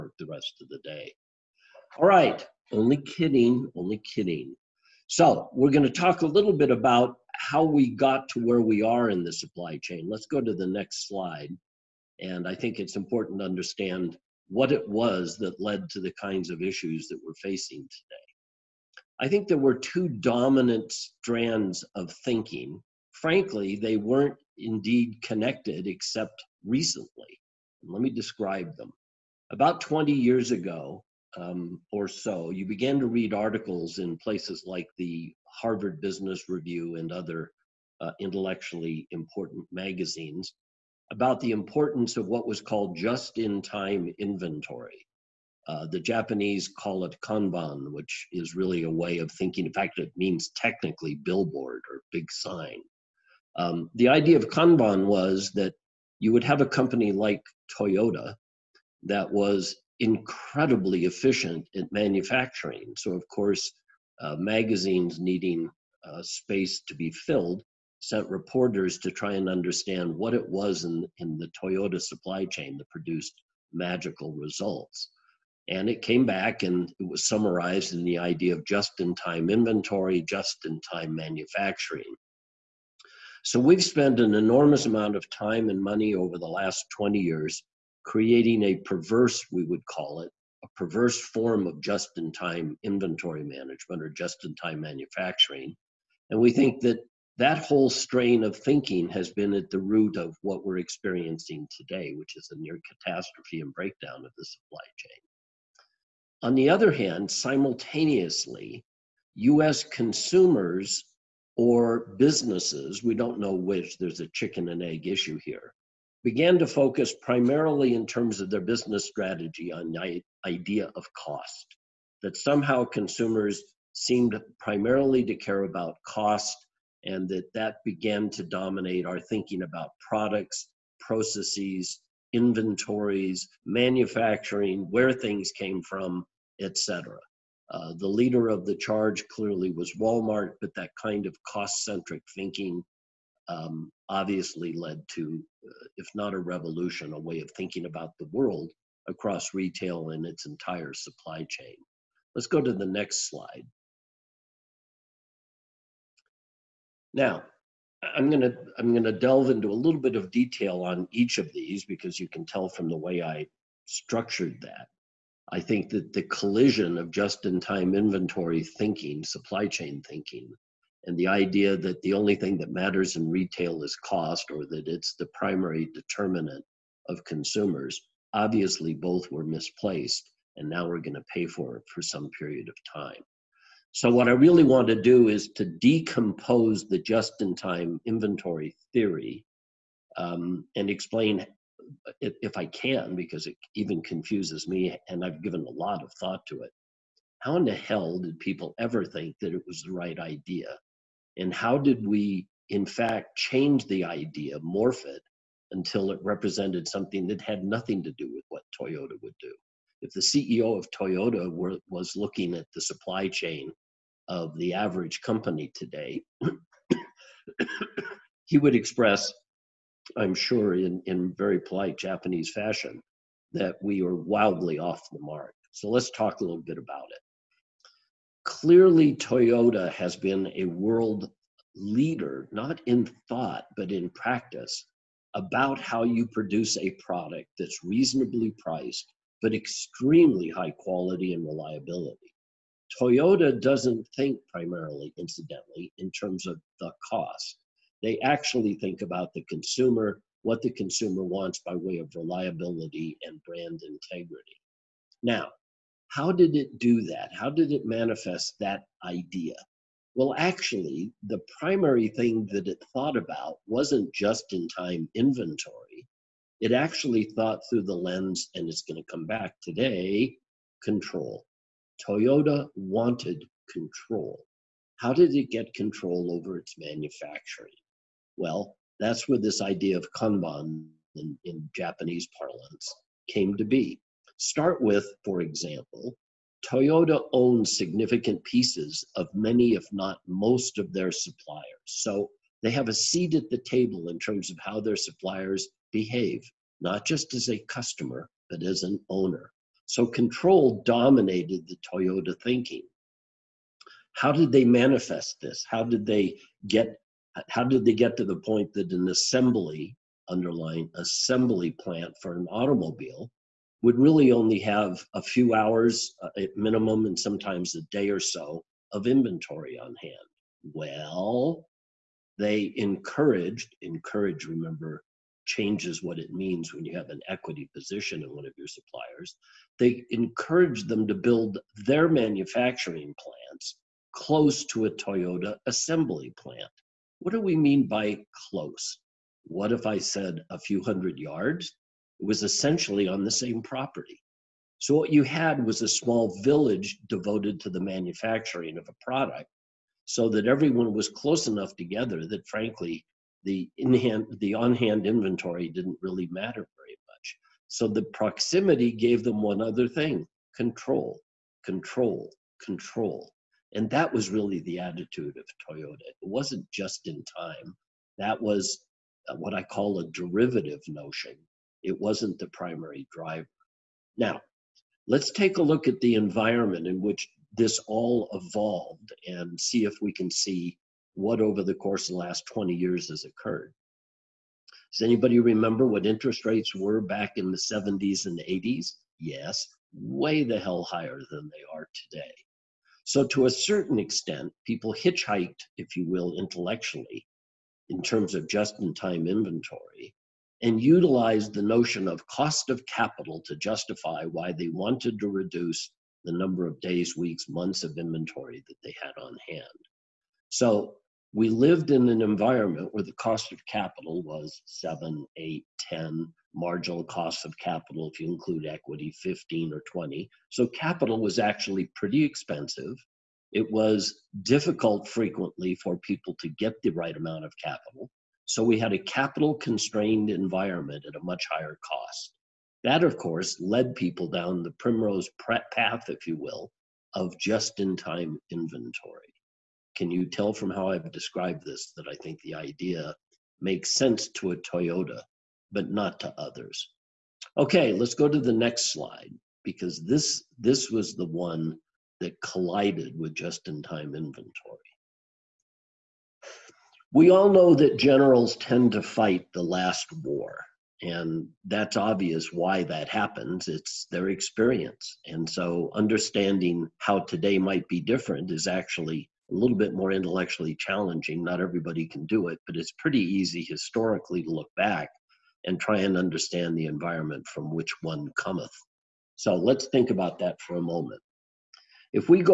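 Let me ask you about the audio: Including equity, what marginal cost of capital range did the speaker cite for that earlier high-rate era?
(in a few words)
15 or 20.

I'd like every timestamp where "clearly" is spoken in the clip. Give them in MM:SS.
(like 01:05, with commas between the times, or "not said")
02:19, 03:48.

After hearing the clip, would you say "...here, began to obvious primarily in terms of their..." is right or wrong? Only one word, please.
wrong.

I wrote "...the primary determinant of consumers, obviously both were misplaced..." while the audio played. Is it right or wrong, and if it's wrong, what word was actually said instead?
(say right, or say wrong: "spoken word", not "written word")
right.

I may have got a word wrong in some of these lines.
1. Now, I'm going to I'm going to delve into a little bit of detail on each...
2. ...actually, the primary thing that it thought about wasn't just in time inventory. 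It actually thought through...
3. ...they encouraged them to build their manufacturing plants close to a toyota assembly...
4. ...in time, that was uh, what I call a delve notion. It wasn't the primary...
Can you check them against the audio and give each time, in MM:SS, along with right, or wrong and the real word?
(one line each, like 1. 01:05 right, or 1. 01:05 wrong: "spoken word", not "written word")
1. 02:37 right
2. 04:20 right
3. 05:29 right
4. 06:07 wrong: "derivative", not "delve".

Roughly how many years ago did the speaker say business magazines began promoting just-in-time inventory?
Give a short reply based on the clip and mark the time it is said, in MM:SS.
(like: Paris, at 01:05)
20 years, at 00:29.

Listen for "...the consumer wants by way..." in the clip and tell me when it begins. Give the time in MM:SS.
04:10.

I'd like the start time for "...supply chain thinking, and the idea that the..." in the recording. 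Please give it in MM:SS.
02:49.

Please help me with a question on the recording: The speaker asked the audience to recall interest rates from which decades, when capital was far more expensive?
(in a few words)
the 70s and 80s.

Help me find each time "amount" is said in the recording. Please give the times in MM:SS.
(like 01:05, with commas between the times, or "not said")
01:24, 07:07.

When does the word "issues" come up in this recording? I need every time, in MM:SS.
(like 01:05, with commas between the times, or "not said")
00:16, 01:55.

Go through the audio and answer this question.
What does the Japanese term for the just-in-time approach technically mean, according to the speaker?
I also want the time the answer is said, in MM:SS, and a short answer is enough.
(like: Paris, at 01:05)
billboard, at 00:51.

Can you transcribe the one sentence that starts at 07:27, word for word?
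Okay, let's go to the next slide because this, this was the one that collided with just-in-time inventory.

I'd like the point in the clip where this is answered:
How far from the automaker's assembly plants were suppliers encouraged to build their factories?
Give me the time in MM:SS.
05:40.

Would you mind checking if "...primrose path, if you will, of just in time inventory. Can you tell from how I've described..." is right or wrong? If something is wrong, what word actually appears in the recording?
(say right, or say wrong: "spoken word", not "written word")
right.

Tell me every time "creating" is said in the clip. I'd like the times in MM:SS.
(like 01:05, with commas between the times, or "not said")
01:28.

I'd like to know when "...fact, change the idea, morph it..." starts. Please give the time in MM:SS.
03:22.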